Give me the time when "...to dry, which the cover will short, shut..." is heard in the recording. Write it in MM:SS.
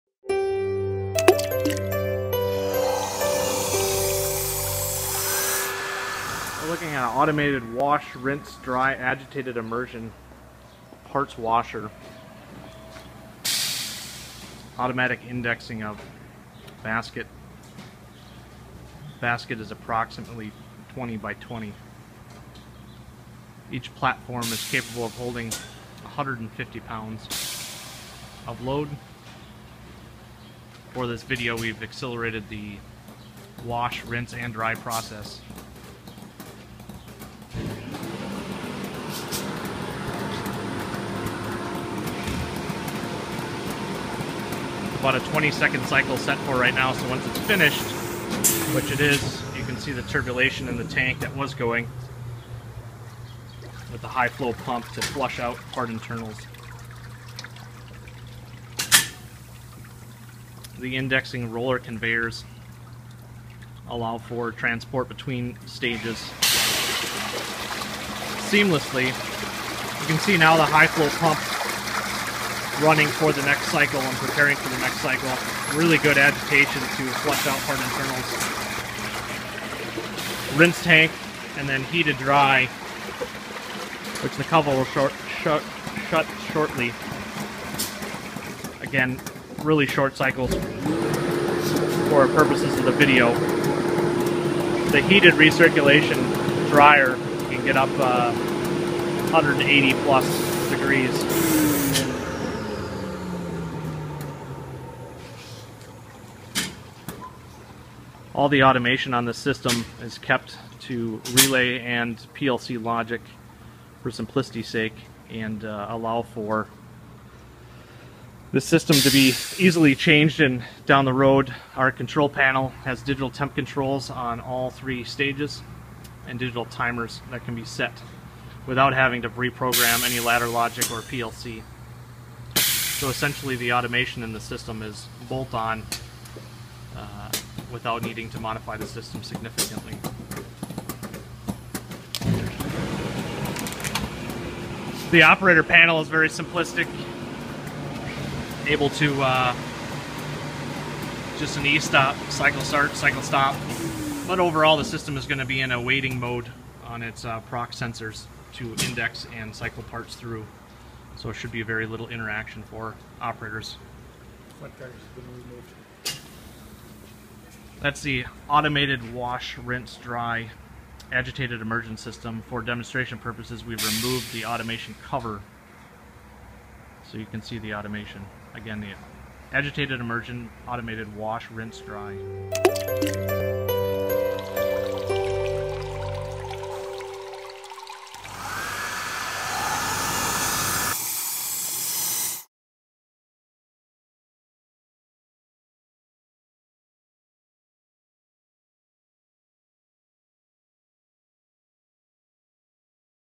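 01:22.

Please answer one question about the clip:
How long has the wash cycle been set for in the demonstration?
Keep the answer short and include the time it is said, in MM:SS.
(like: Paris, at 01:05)
20 seconds, at 00:45.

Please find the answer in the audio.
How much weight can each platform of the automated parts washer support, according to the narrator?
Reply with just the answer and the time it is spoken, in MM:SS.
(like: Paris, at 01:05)
150 pounds, at 00:26.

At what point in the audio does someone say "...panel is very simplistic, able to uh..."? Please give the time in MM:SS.
02:25.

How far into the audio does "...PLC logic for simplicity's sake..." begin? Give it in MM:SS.
01:52.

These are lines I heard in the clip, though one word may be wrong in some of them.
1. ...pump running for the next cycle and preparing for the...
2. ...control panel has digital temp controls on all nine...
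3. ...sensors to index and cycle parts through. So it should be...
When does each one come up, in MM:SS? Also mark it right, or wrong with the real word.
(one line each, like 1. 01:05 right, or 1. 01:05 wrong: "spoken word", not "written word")
1. 01:11 right
2. 02:01 wrong: "three", not "nine"
3. 02:37 right.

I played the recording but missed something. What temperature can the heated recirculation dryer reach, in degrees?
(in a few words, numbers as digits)
180 plus degrees.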